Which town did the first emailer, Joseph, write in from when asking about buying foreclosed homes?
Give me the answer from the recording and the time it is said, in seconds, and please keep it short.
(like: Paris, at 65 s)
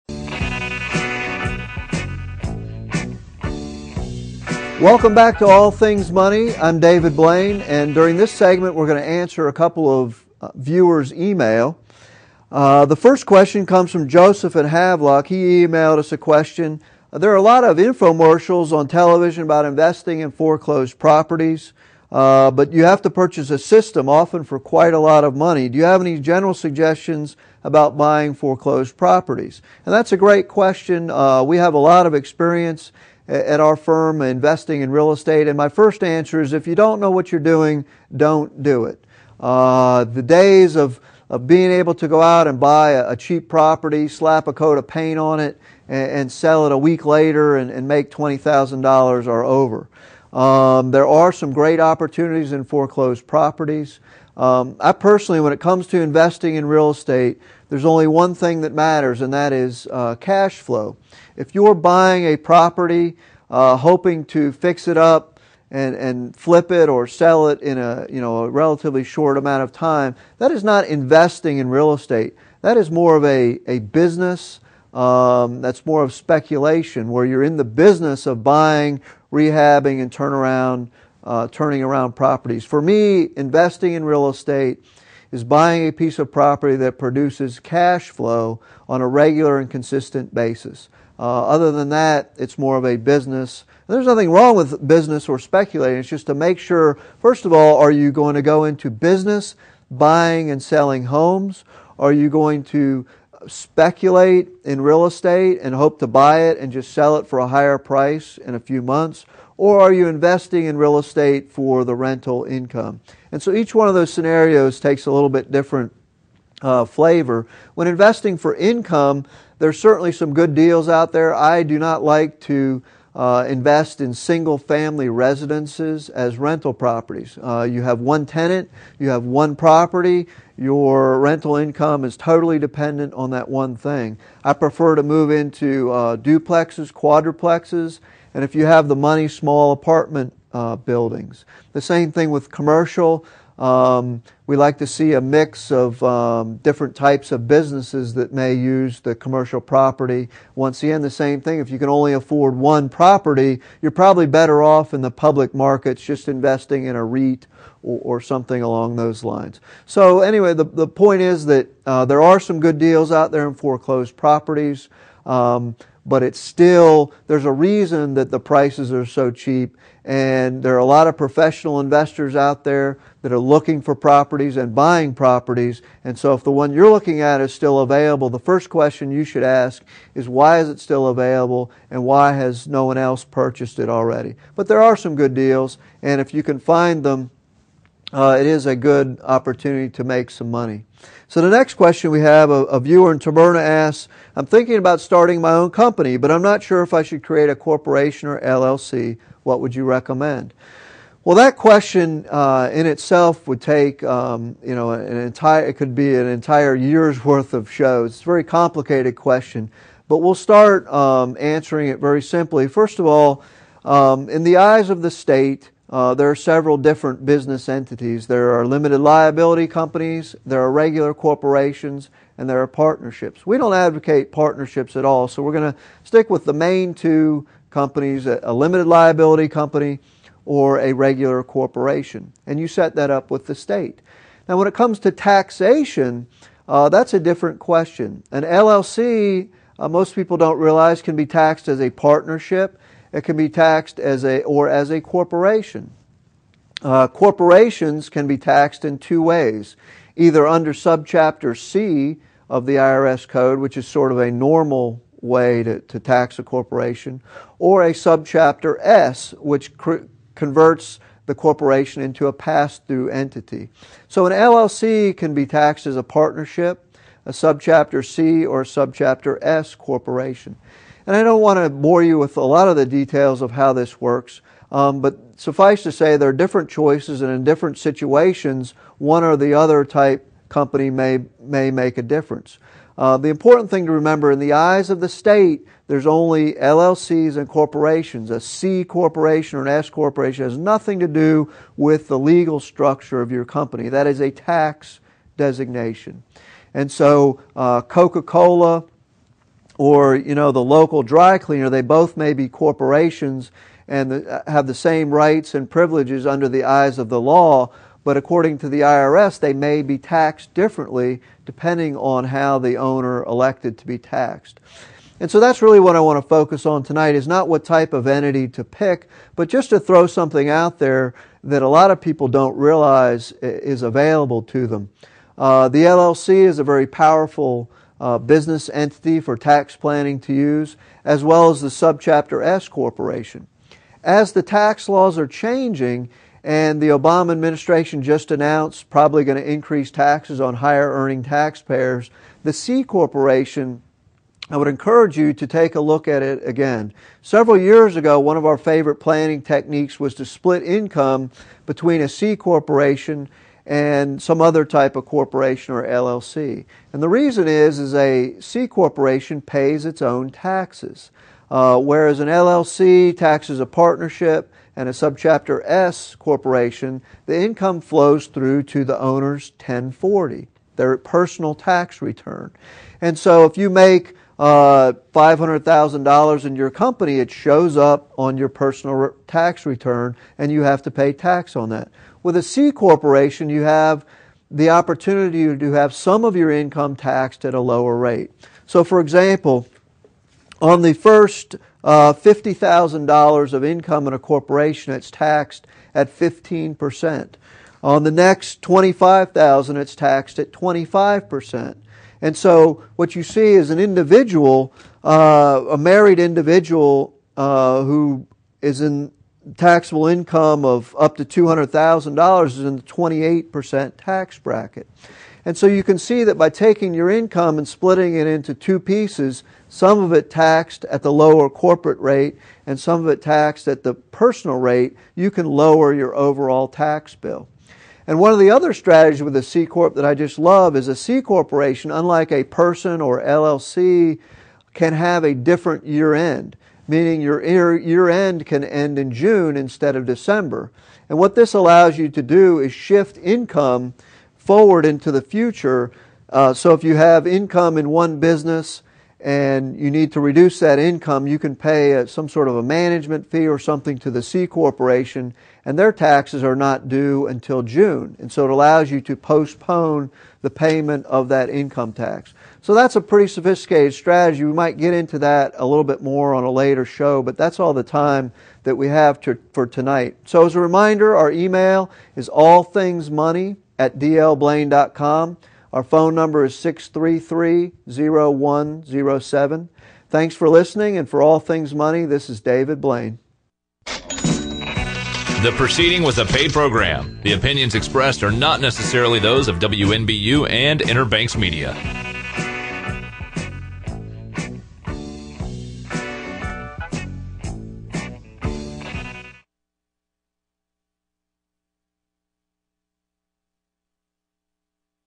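Havelock, at 14 s.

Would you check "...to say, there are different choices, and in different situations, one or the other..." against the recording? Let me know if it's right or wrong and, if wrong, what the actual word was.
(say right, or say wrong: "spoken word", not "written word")
right.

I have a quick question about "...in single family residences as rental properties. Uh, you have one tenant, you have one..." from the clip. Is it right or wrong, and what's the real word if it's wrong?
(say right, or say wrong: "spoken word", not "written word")
right.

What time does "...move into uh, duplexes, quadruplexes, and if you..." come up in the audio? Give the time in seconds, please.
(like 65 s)
135 s.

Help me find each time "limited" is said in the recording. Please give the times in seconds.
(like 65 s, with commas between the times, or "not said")
218 s, 228 s.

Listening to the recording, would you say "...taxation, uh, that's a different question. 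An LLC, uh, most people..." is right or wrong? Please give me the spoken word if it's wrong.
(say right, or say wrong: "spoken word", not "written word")
right.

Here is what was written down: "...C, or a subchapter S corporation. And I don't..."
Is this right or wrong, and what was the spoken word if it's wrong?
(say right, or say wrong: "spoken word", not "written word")
right.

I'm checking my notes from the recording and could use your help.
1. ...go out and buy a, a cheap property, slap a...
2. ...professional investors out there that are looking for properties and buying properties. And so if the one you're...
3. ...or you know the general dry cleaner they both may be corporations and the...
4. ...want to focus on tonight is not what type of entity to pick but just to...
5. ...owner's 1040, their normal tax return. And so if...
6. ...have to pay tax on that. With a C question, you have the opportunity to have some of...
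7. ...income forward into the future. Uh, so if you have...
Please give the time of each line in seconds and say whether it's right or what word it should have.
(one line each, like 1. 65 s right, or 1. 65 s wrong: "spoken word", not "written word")
1. 42 s right
2. 171 s right
3. 299 s wrong: "local", not "general"
4. 315 s right
5. 368 s wrong: "personal", not "normal"
6. 380 s wrong: "corporation", not "question"
7. 443 s right.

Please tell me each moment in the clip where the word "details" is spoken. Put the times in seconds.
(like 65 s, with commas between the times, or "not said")
272 s.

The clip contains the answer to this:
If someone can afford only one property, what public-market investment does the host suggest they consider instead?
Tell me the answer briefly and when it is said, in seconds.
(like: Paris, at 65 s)
A REIT, at 156 s.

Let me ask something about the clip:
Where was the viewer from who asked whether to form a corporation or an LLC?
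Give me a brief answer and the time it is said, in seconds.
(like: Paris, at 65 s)
Taberna, at 193 s.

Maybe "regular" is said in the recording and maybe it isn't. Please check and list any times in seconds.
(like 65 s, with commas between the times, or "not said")
89 s, 220 s, 230 s.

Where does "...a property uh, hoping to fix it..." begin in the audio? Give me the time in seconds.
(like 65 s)
62 s.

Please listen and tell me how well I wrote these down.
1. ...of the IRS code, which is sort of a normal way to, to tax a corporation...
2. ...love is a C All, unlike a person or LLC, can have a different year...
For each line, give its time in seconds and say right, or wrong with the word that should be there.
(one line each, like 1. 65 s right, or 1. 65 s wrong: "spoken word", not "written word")
1. 252 s right
2. 430 s wrong: "Corporation", not "All".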